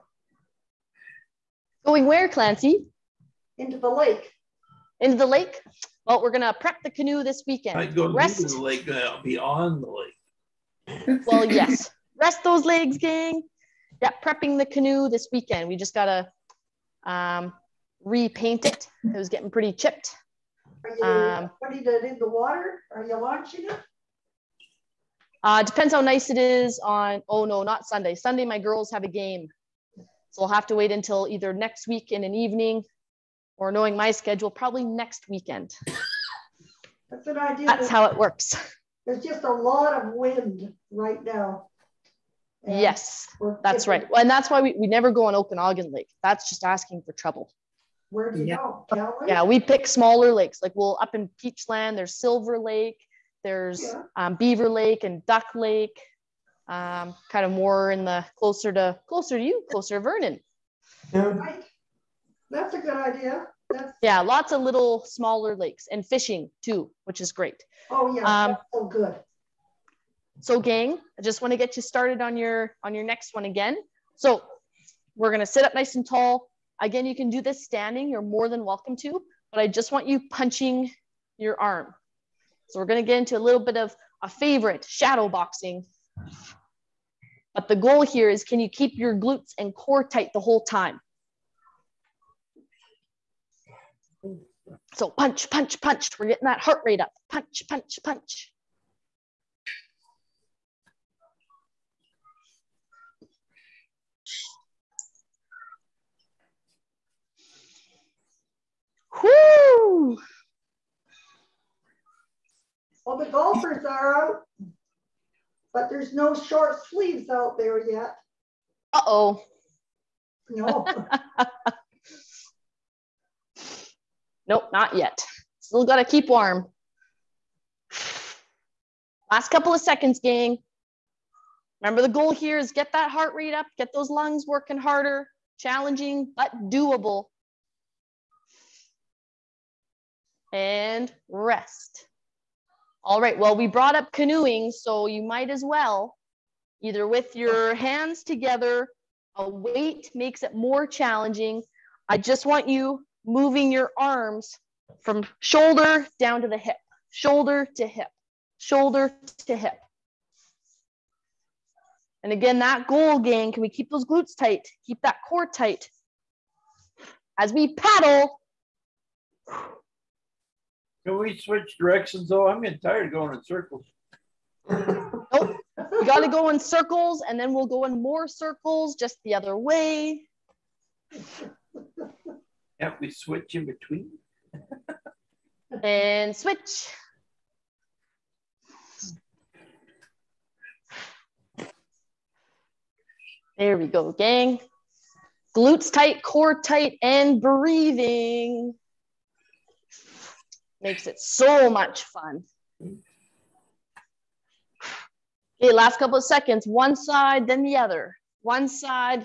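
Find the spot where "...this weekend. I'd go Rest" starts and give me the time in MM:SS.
00:07.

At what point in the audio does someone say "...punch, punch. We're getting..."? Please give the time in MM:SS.
01:35.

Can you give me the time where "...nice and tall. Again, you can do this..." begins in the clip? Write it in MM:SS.
01:15.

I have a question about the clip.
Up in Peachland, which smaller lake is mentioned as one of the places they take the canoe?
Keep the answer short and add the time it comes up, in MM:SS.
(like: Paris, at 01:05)
Silver Lake, at 00:52.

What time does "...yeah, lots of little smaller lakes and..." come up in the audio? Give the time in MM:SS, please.
01:04.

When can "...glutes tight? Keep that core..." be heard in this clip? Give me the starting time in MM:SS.
02:44.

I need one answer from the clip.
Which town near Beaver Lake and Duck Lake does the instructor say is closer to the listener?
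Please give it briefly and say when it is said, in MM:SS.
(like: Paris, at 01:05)
Vernon, at 00:59.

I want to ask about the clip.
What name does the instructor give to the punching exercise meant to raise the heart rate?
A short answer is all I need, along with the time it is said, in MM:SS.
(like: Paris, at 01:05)
shadow boxing, at 01:24.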